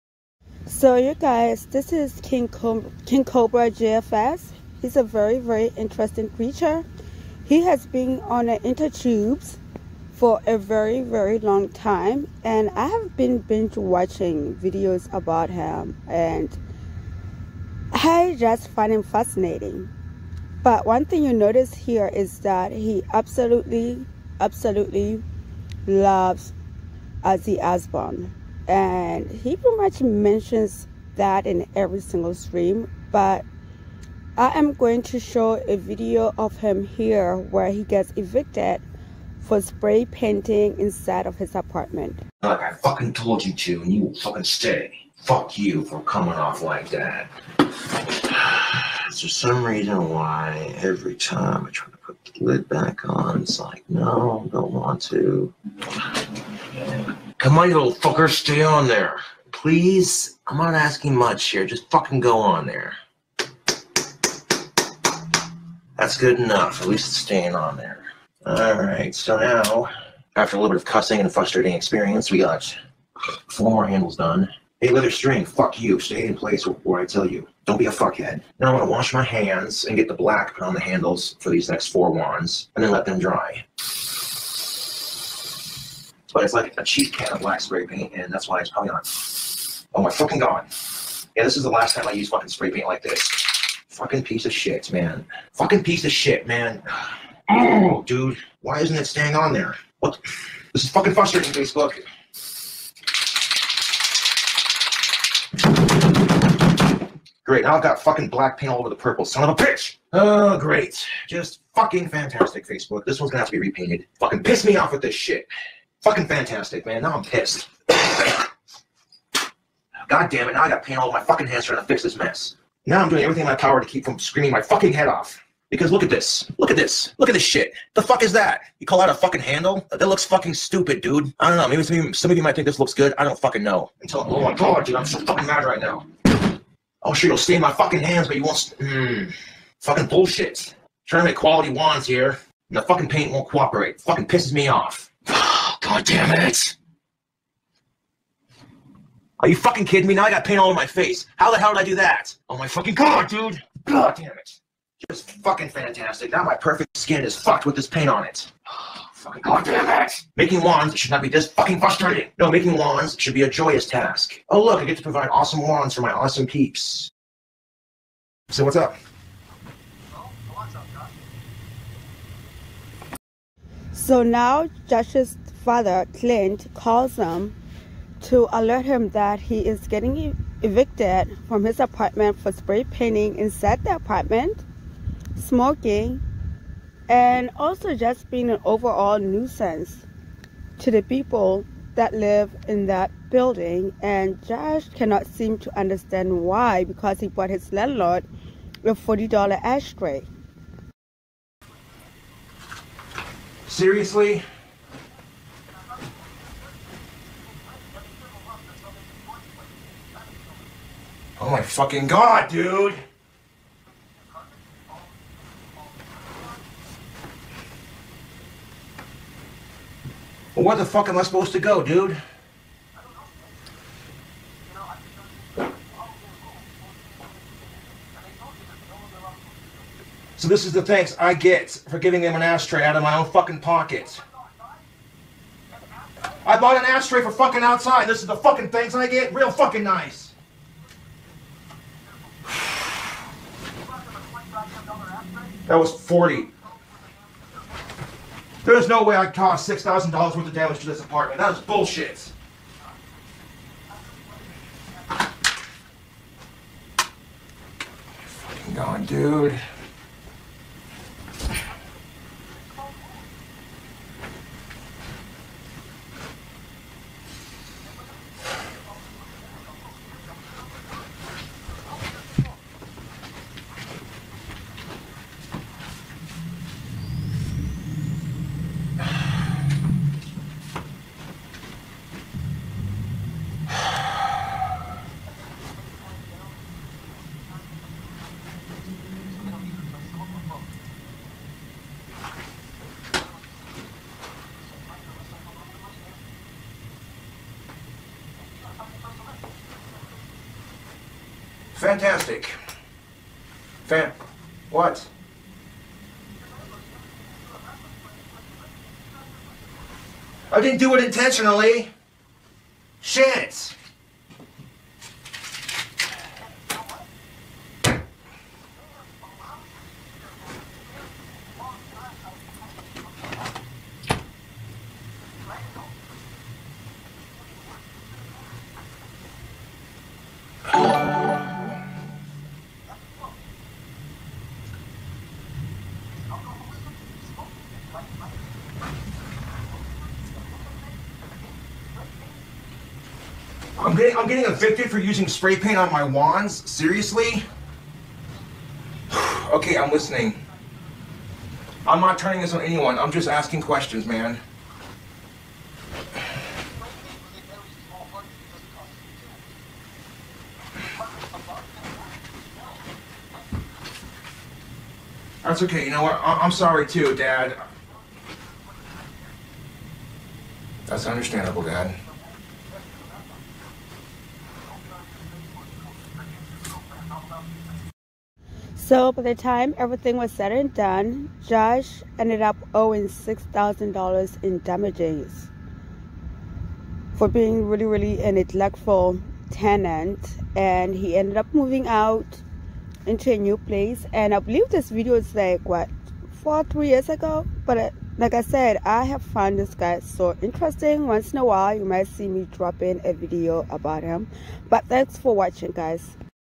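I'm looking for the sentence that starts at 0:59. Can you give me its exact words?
Please, I'm not asking much here.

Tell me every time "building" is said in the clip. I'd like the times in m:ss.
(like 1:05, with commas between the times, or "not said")
3:13.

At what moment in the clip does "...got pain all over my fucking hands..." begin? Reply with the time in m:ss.
2:00.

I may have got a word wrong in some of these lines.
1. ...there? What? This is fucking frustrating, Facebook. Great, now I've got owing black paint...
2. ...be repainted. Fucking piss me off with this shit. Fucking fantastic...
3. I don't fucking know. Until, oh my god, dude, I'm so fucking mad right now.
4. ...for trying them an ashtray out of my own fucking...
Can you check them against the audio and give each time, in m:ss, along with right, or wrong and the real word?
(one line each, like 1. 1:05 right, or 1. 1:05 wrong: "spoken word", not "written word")
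1. 1:39 wrong: "fucking", not "owing"
2. 1:53 right
3. 2:13 right
4. 3:51 wrong: "giving", not "trying".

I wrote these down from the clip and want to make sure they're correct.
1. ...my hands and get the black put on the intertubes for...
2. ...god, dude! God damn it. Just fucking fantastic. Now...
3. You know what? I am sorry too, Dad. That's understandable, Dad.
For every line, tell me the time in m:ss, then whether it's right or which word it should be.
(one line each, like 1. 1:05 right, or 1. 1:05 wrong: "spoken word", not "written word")
1. 1:19 wrong: "handles", not "intertubes"
2. 2:32 right
3. 6:05 right.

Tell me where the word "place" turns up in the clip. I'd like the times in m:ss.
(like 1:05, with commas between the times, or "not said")
1:16, 6:33.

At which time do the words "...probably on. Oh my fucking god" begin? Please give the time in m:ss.
1:28.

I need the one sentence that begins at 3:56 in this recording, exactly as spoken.
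I bought an ashtray for fucking outside.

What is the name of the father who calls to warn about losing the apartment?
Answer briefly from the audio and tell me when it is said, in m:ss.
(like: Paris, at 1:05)
Clint, at 2:56.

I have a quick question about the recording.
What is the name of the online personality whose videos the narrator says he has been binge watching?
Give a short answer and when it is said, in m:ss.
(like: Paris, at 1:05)
King Cobra JFS, at 0:03.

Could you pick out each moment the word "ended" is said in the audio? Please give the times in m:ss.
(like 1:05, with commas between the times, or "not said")
6:22, 6:31.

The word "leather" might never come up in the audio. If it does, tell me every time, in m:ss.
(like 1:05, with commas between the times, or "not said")
1:14.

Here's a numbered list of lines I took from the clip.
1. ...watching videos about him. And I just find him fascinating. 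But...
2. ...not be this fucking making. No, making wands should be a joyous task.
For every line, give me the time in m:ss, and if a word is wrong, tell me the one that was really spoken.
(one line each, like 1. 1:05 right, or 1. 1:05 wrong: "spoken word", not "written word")
1. 0:13 right
2. 2:41 wrong: "frustrating", not "making".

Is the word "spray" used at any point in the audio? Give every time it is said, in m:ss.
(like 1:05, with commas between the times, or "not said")
0:39, 1:27, 1:32, 3:02, 5:45.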